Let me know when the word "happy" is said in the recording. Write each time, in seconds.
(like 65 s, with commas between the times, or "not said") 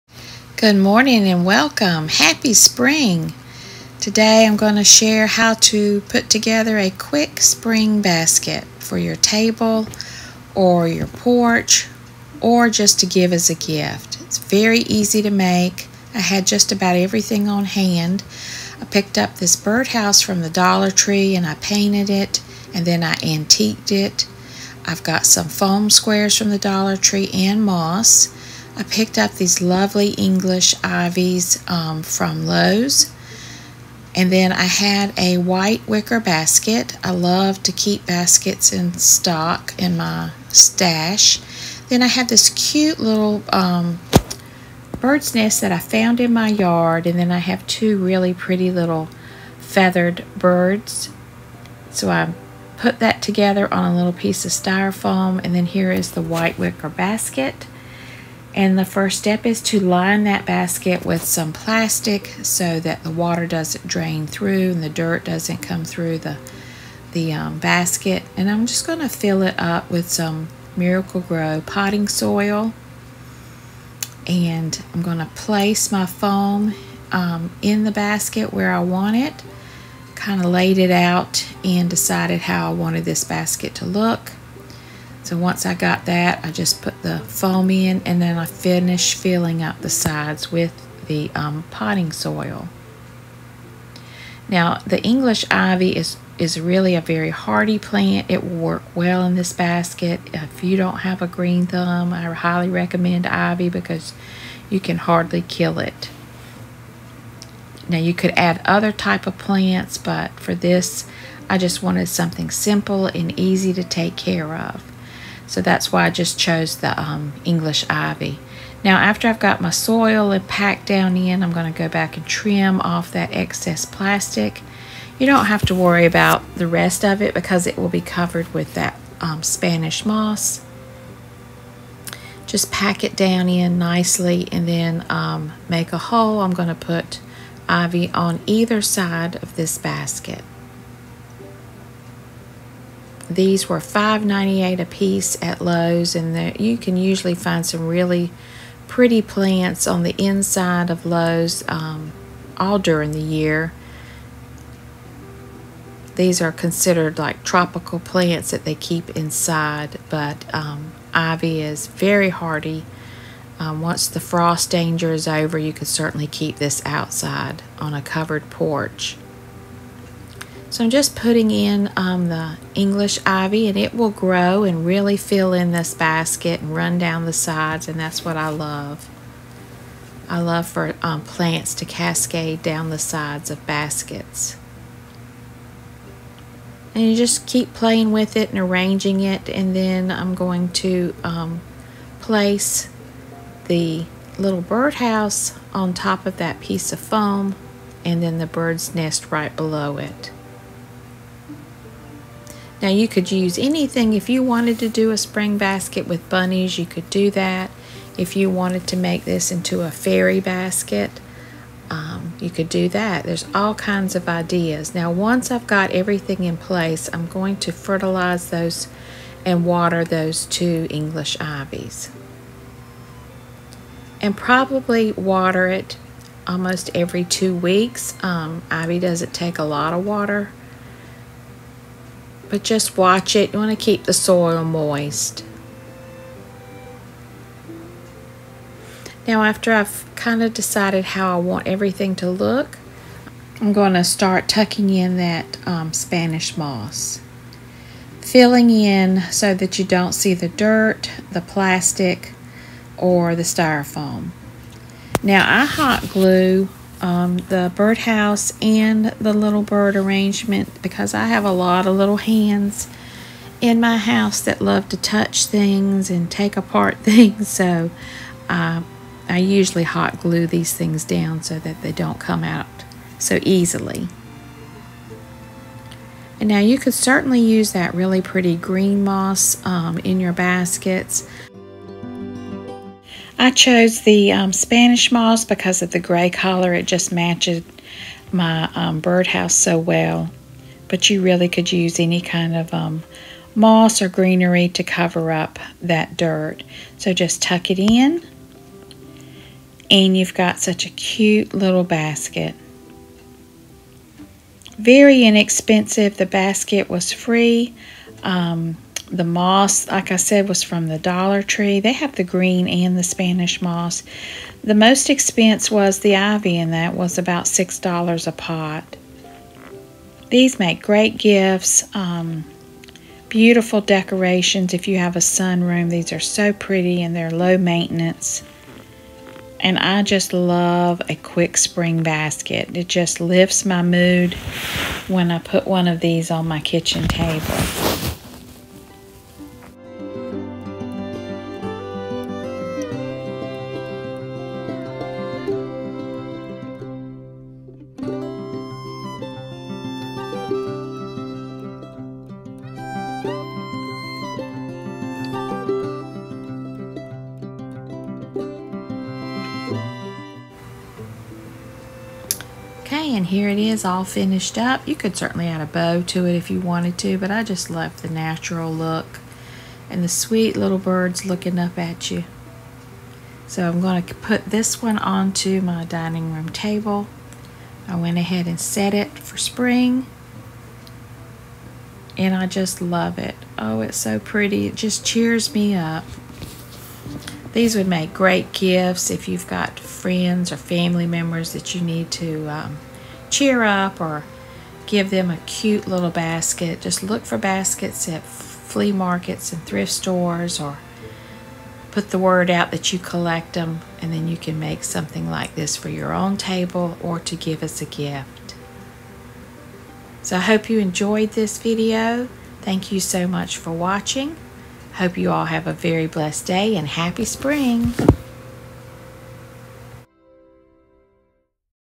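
2 s, 416 s.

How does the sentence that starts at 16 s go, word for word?
I had just about everything on hand.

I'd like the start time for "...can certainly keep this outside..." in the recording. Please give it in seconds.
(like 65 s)
165 s.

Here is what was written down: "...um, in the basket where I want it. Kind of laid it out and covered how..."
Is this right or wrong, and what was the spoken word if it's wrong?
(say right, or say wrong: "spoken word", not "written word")
wrong: "decided", not "covered".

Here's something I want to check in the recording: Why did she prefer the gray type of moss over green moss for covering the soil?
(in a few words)
gray color.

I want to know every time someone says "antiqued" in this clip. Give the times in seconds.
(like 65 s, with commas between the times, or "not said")
23 s.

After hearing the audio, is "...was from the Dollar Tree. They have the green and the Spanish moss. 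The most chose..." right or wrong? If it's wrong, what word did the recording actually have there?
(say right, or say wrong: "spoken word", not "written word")
wrong: "expense", not "chose".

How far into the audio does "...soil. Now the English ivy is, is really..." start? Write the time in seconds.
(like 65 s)
92 s.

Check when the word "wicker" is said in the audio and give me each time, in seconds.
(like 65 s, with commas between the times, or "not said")
35 s, 56 s.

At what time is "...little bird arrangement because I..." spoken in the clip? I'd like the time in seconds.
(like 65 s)
259 s.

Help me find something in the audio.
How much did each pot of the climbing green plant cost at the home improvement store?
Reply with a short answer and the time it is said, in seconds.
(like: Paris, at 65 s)
$5.98, at 143 s.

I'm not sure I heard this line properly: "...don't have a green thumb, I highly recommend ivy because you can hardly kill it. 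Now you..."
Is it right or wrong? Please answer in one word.
right.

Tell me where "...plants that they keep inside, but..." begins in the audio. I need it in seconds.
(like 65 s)
158 s.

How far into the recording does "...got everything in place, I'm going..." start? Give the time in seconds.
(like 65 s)
215 s.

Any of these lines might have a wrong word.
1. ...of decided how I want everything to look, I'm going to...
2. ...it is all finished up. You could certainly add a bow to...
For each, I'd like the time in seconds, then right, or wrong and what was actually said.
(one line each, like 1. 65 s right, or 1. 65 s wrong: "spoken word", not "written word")
1. 240 s right
2. 363 s right.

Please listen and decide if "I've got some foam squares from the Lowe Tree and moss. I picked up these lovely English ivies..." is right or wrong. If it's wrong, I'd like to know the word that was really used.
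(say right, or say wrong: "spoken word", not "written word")
wrong: "Dollar", not "Lowe".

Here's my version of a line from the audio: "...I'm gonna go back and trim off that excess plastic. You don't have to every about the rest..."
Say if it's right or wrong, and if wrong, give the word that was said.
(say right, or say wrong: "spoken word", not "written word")
wrong: "worry", not "every".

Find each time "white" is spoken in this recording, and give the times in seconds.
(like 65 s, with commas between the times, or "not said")
35 s, 56 s.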